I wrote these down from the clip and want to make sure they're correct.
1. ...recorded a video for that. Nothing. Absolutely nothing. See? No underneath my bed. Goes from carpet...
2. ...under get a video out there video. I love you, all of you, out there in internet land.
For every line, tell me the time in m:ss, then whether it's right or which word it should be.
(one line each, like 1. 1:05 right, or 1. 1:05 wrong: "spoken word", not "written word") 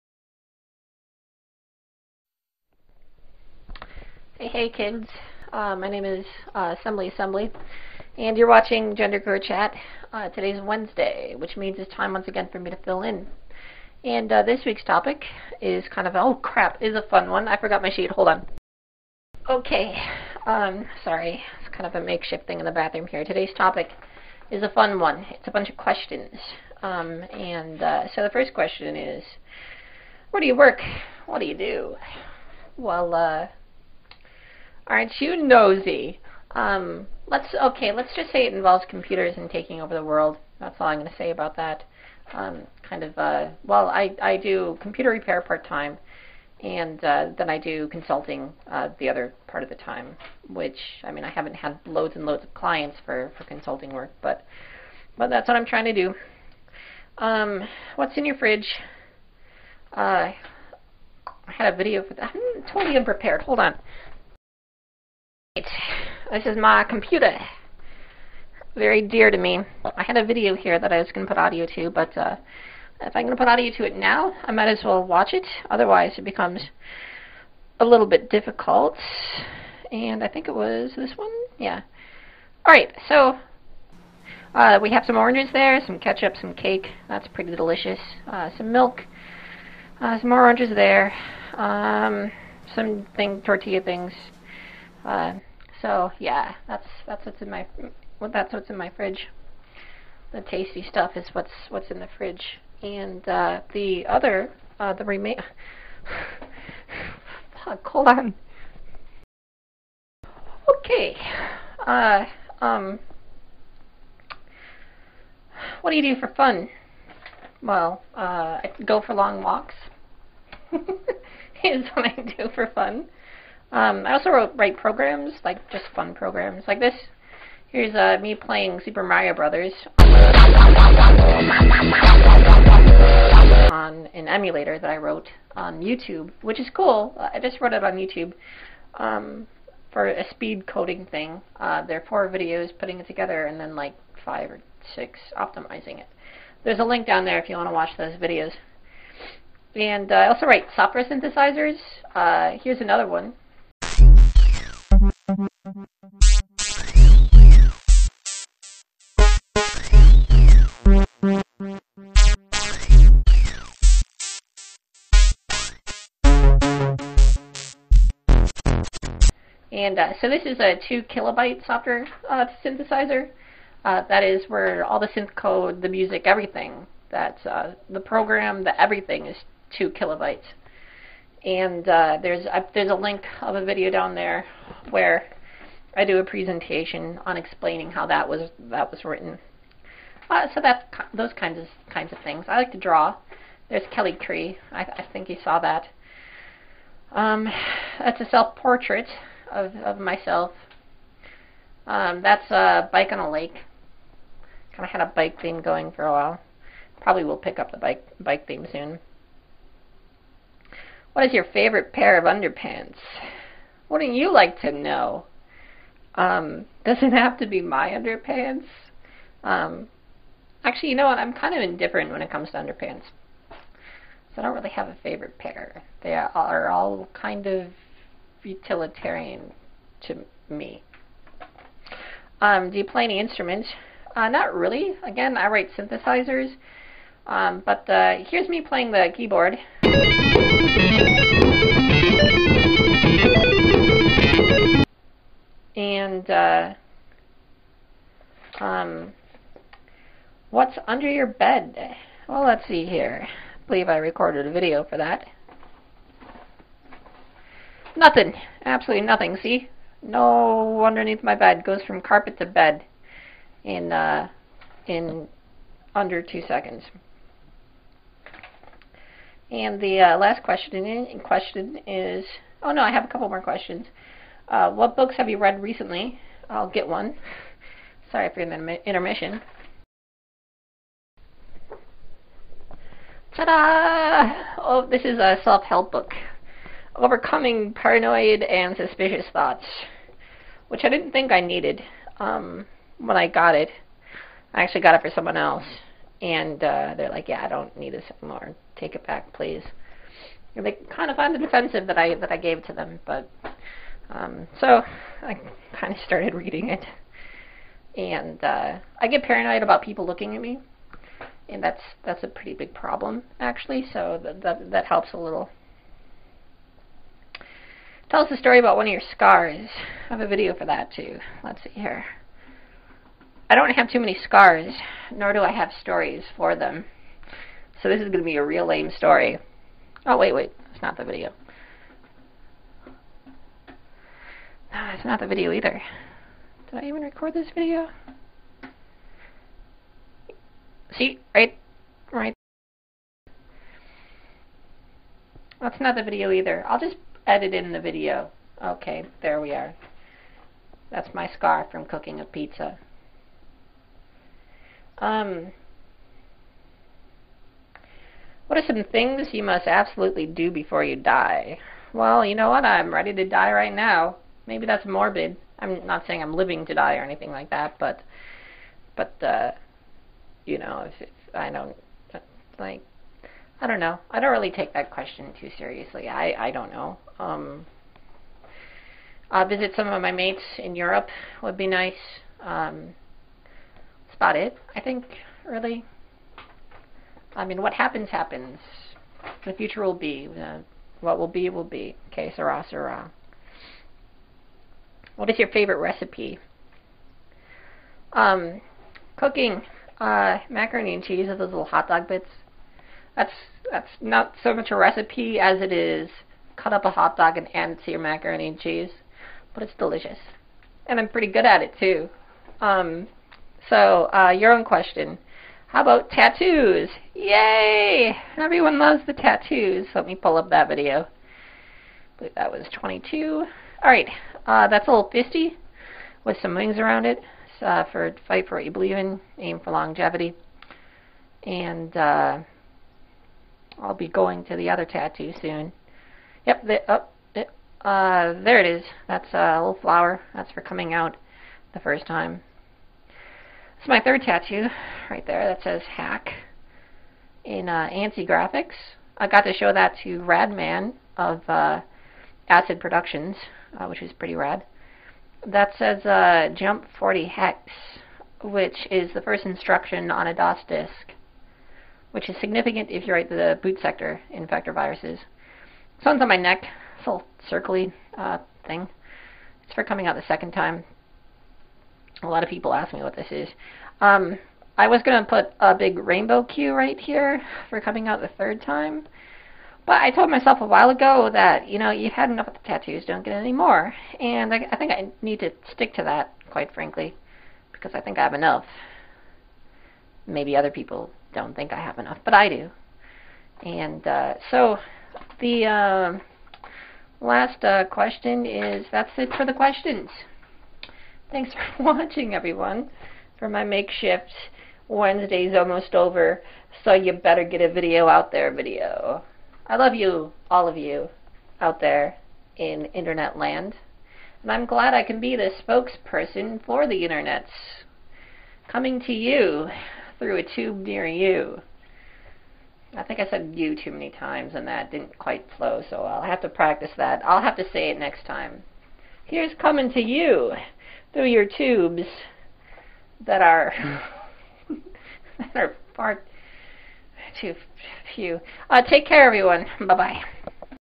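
1. 4:13 right
2. 8:27 wrong: "better", not "under".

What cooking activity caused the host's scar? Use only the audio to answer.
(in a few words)
Cooking a pizza.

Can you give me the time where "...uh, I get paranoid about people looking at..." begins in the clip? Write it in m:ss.
5:08.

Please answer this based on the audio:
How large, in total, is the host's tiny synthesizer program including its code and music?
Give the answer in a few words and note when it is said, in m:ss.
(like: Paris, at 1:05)
2 kilobytes, at 2:59.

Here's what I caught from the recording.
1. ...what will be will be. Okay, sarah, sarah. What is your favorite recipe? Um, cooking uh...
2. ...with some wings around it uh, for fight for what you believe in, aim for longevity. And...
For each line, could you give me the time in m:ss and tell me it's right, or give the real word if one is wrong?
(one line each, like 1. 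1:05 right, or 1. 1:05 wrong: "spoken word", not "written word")
1. 6:31 right
2. 7:06 right.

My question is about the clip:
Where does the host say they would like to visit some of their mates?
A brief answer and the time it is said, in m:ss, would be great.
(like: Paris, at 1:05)
Europe, at 6:20.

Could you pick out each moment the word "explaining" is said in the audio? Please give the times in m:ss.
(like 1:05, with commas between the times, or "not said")
3:07.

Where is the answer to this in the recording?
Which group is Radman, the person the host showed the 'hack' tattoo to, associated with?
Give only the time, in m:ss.
7:32.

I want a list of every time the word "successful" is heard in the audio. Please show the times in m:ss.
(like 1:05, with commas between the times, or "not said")
not said.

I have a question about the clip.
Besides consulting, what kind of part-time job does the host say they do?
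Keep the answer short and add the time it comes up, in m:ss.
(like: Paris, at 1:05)
Computer repair, at 0:44.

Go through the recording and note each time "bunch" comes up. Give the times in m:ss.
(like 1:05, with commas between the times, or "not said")
0:25.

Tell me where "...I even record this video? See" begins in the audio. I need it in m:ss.
5:36.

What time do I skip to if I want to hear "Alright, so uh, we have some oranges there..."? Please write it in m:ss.
1:22.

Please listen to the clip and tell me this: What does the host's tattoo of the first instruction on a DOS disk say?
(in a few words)
Jump 40 hex.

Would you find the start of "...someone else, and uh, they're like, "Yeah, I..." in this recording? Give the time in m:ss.
4:55.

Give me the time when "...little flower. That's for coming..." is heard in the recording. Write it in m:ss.
7:19.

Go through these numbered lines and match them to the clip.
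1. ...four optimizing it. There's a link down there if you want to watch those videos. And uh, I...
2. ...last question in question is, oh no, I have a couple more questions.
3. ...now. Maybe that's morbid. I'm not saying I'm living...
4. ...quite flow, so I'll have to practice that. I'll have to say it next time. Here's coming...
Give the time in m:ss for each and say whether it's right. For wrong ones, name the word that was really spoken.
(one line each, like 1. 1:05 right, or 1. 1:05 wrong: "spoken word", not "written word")
1. 2:24 wrong: "six", not "four"
2. 4:30 right
3. 6:03 right
4. 8:45 right.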